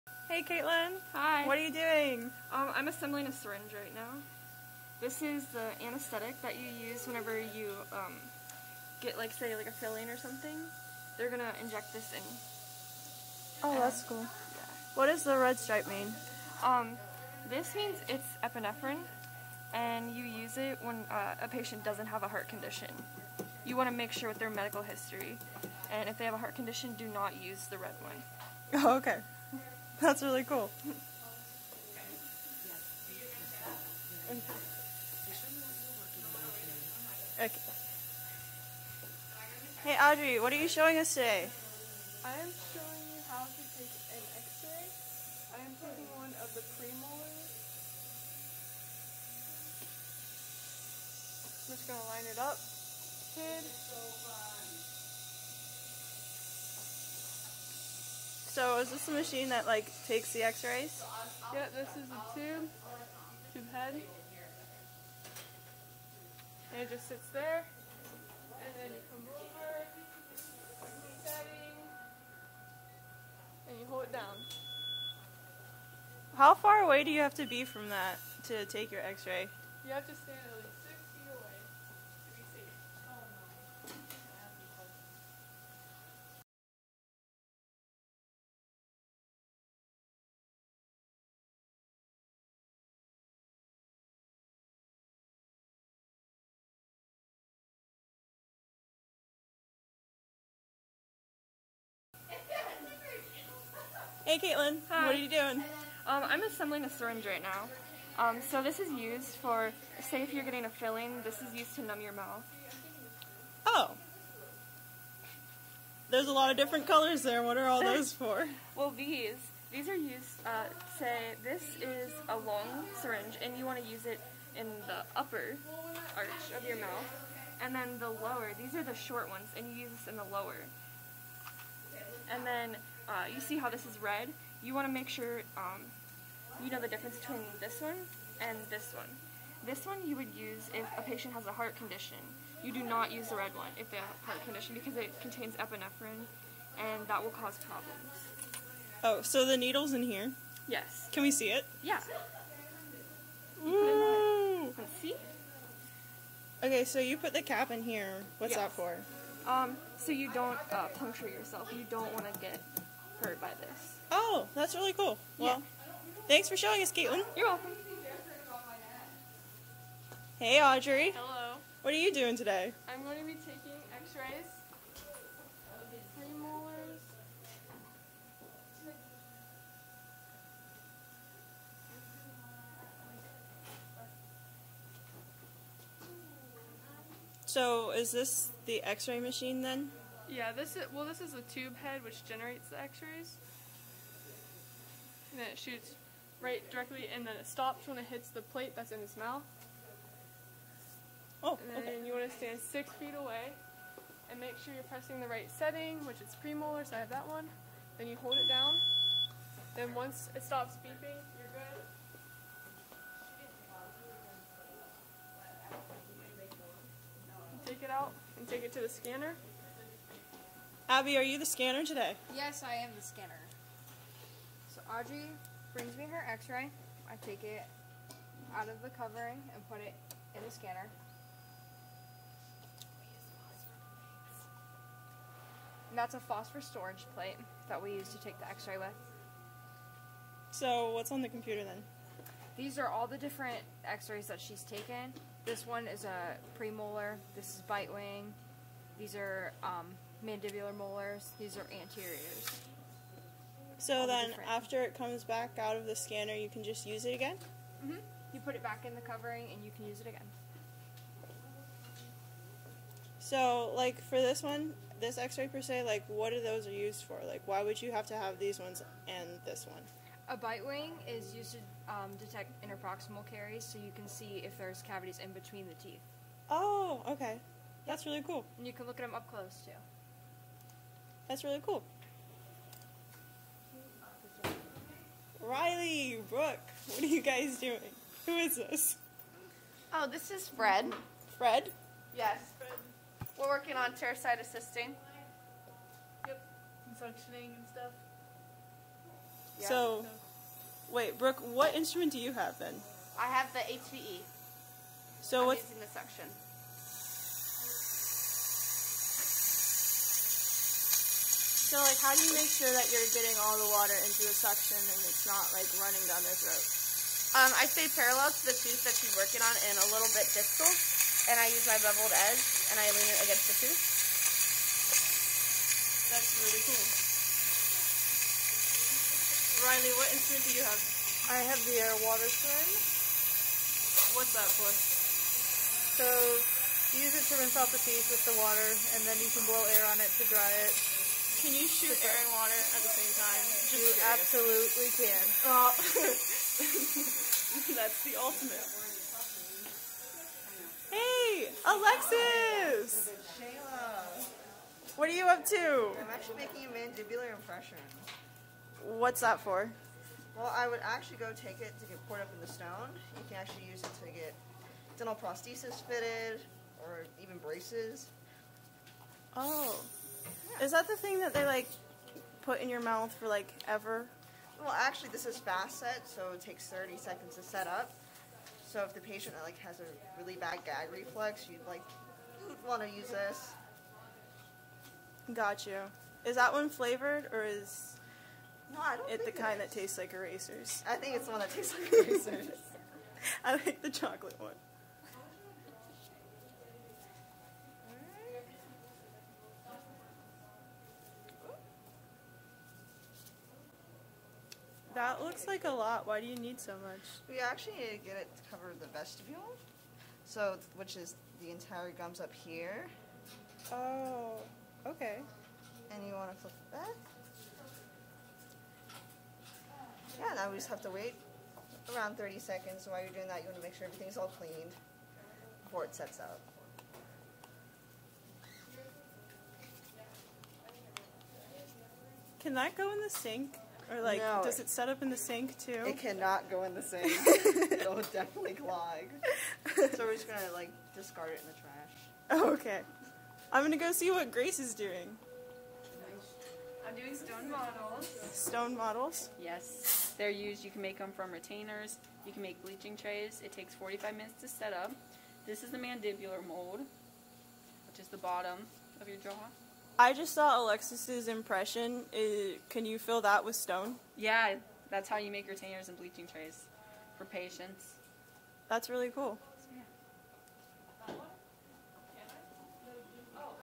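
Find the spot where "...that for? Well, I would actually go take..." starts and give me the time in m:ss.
5:59.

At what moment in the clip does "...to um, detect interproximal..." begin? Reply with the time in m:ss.
4:31.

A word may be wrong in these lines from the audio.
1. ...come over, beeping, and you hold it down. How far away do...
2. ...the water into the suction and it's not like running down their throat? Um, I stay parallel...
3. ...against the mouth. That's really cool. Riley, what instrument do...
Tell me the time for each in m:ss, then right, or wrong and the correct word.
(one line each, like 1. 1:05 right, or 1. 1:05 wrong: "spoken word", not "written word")
1. 1:09 wrong: "setting", not "beeping"
2. 5:13 right
3. 5:23 wrong: "tooth", not "mouth".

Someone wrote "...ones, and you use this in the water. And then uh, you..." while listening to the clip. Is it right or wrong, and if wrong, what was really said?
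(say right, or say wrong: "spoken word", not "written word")
wrong: "lower", not "water".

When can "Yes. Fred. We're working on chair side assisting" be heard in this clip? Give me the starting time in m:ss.
4:52.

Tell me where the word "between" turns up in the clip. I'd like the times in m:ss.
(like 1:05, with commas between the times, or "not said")
2:17, 4:35.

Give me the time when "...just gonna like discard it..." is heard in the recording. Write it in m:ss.
7:20.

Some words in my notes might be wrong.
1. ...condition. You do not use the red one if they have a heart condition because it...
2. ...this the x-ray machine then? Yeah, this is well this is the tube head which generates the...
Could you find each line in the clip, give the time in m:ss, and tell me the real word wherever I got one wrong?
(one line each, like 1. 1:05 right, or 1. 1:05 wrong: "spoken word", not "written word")
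1. 2:21 right
2. 3:08 right.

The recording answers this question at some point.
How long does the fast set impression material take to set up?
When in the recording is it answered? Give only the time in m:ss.
6:16.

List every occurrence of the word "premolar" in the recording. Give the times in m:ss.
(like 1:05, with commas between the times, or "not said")
0:46, 3:26, 4:06.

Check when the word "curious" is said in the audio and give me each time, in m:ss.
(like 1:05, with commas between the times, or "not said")
5:43.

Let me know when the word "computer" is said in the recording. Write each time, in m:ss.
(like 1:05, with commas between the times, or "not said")
4:01.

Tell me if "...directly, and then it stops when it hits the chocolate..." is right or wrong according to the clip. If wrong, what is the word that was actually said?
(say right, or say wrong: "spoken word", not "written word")
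wrong: "plate", not "chocolate".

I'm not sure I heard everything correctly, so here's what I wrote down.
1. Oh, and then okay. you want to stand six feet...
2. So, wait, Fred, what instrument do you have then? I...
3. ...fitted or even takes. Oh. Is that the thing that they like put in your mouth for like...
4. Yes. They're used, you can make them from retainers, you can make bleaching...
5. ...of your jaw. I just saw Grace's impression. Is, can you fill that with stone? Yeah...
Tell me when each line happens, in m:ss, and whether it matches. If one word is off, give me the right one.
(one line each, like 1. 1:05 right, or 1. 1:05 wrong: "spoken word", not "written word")
1. 3:21 right
2. 4:59 wrong: "Brooke", not "Fred"
3. 6:05 wrong: "braces", not "takes"
4. 7:29 right
5. 7:39 wrong: "Alexis", not "Grace".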